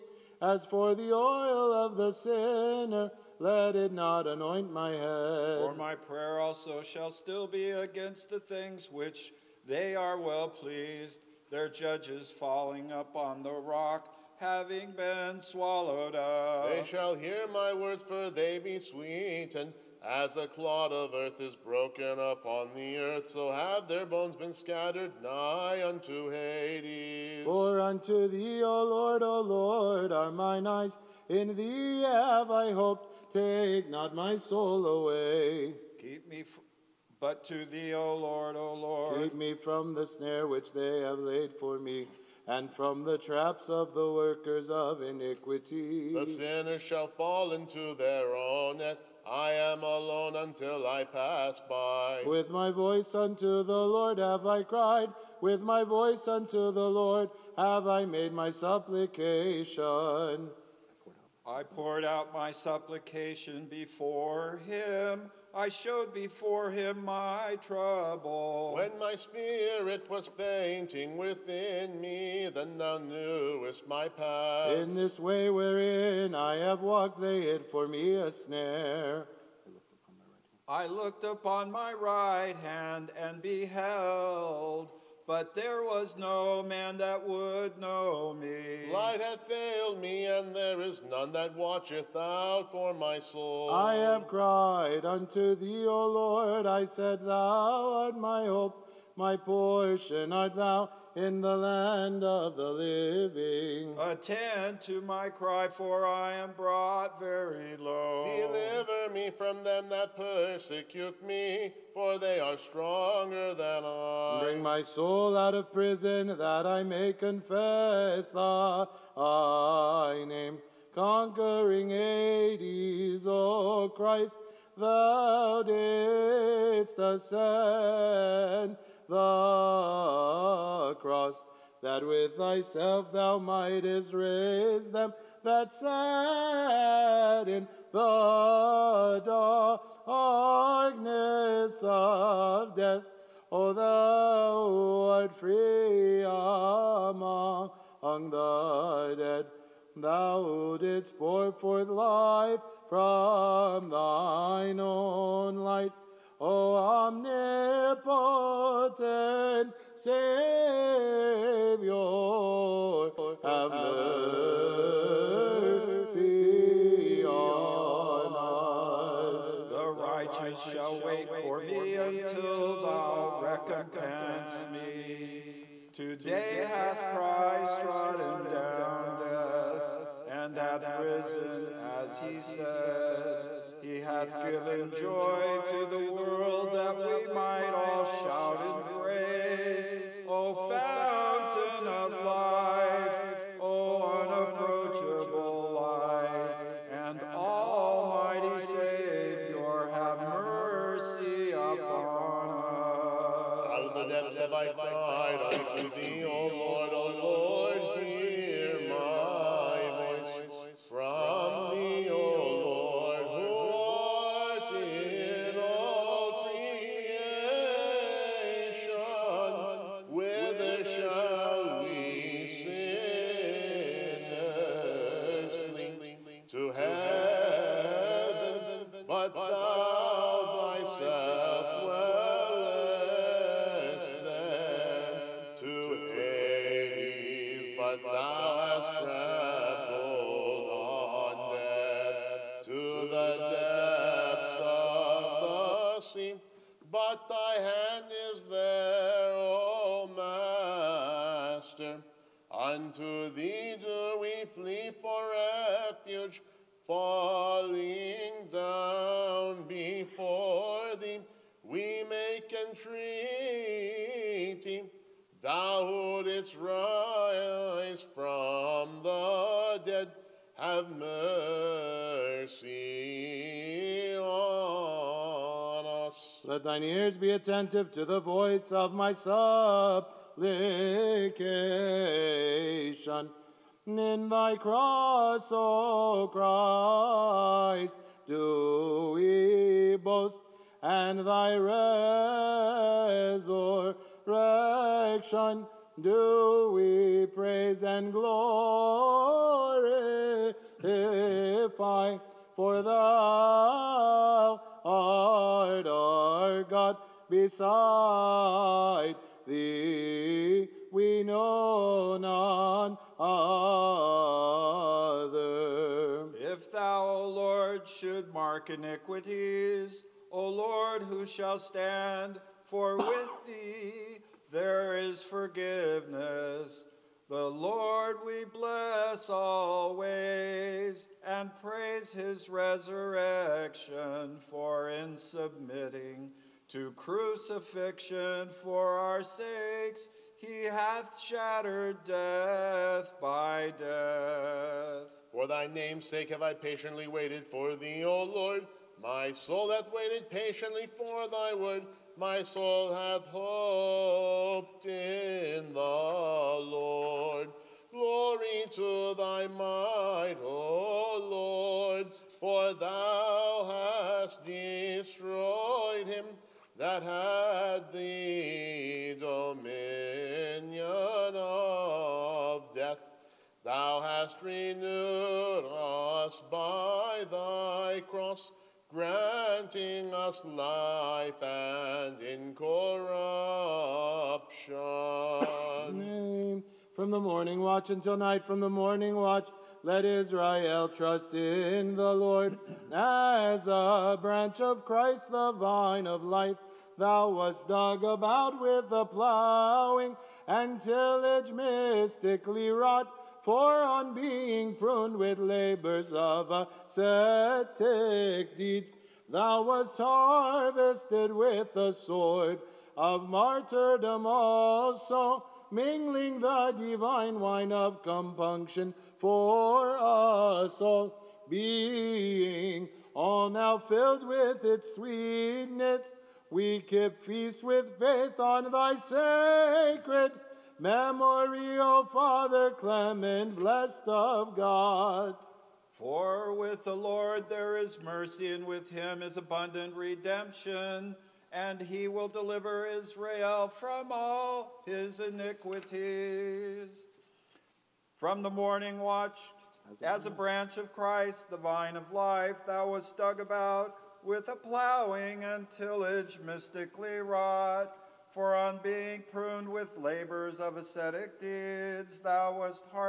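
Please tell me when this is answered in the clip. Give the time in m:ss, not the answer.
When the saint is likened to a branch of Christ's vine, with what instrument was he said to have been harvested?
6:51.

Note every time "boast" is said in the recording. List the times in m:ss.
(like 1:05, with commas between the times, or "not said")
4:49.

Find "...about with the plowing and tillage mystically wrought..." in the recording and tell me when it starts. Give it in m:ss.
6:38.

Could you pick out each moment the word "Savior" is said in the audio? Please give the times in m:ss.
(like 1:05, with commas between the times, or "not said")
2:39, 3:18.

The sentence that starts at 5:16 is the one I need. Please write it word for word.
If thou, O Lord, should mark iniquities, O Lord, who shall stand?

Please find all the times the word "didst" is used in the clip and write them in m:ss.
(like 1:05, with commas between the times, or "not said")
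2:05, 2:30, 4:26.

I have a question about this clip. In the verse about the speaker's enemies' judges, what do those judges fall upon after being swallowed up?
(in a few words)
The rock.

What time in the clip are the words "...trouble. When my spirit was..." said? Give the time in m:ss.
1:07.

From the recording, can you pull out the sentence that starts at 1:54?
Bring my soul out of prison, that I may confess thy name.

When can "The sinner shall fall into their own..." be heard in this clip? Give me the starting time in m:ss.
0:46.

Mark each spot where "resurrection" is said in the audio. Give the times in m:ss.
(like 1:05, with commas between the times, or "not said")
4:51, 5:32.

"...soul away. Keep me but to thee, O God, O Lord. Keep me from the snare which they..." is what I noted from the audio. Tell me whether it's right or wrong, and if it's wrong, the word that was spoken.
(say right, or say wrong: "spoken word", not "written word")
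wrong: "Lord", not "God".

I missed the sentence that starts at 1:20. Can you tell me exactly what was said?
I looked upon my right hand, my right hand and beheld but there was no man that would know me.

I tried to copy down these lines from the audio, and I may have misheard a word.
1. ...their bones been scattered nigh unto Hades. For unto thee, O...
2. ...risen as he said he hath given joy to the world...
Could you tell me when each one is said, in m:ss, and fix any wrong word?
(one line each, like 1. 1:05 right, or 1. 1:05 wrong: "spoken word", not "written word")
1. 0:23 right
2. 3:00 right.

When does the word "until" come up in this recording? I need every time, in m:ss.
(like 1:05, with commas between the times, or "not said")
0:50, 2:51, 6:27.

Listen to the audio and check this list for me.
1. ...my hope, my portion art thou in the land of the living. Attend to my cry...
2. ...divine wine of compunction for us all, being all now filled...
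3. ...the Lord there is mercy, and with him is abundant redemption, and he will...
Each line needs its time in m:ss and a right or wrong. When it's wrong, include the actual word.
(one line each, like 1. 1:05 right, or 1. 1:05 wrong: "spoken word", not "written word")
1. 1:38 right
2. 6:56 right
3. 7:16 right.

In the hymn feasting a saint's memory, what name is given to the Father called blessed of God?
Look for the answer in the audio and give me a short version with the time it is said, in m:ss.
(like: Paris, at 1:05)
Clement, at 7:12.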